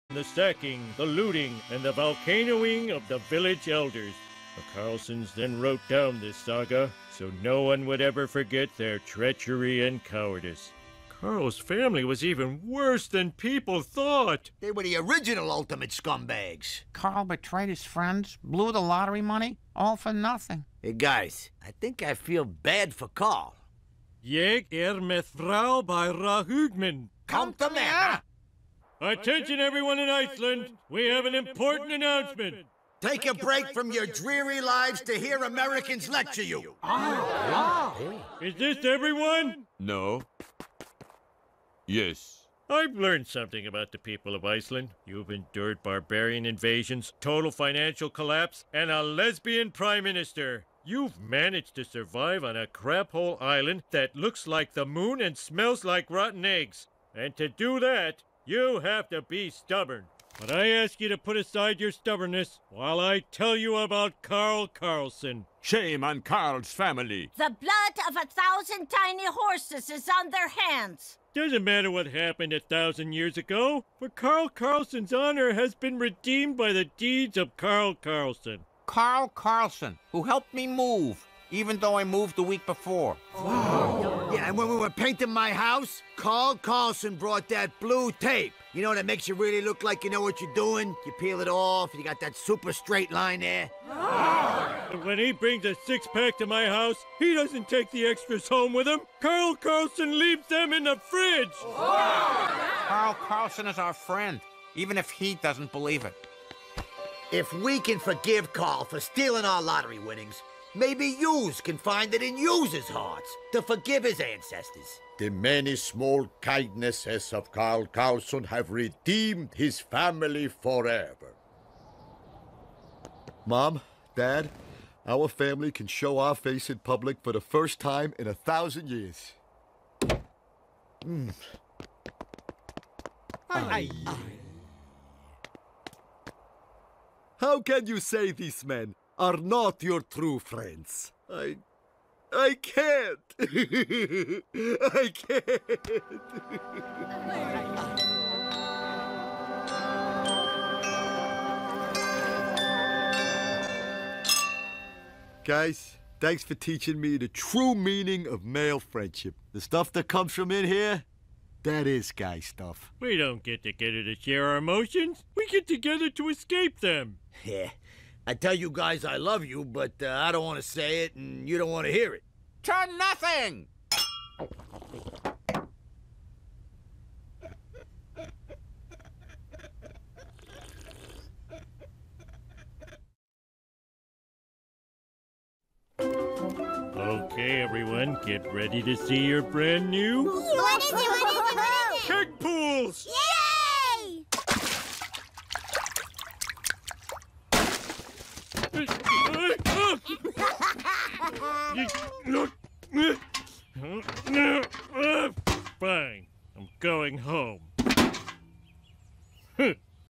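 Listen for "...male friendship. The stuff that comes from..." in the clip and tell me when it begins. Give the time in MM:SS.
02:38.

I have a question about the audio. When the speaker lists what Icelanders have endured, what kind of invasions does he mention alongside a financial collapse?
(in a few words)
barbarian invasions.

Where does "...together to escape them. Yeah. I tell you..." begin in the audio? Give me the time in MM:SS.
02:45.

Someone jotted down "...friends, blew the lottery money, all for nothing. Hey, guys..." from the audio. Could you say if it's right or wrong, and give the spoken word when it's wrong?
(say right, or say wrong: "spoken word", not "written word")
right.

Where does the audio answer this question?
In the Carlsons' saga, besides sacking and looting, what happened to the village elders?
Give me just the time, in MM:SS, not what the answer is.
00:01.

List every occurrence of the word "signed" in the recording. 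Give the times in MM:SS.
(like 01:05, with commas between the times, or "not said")
not said.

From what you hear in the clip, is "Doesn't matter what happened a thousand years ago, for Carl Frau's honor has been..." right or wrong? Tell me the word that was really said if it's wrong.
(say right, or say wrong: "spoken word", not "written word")
wrong: "Carlson", not "Frau".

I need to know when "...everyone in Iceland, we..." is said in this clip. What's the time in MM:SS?
00:29.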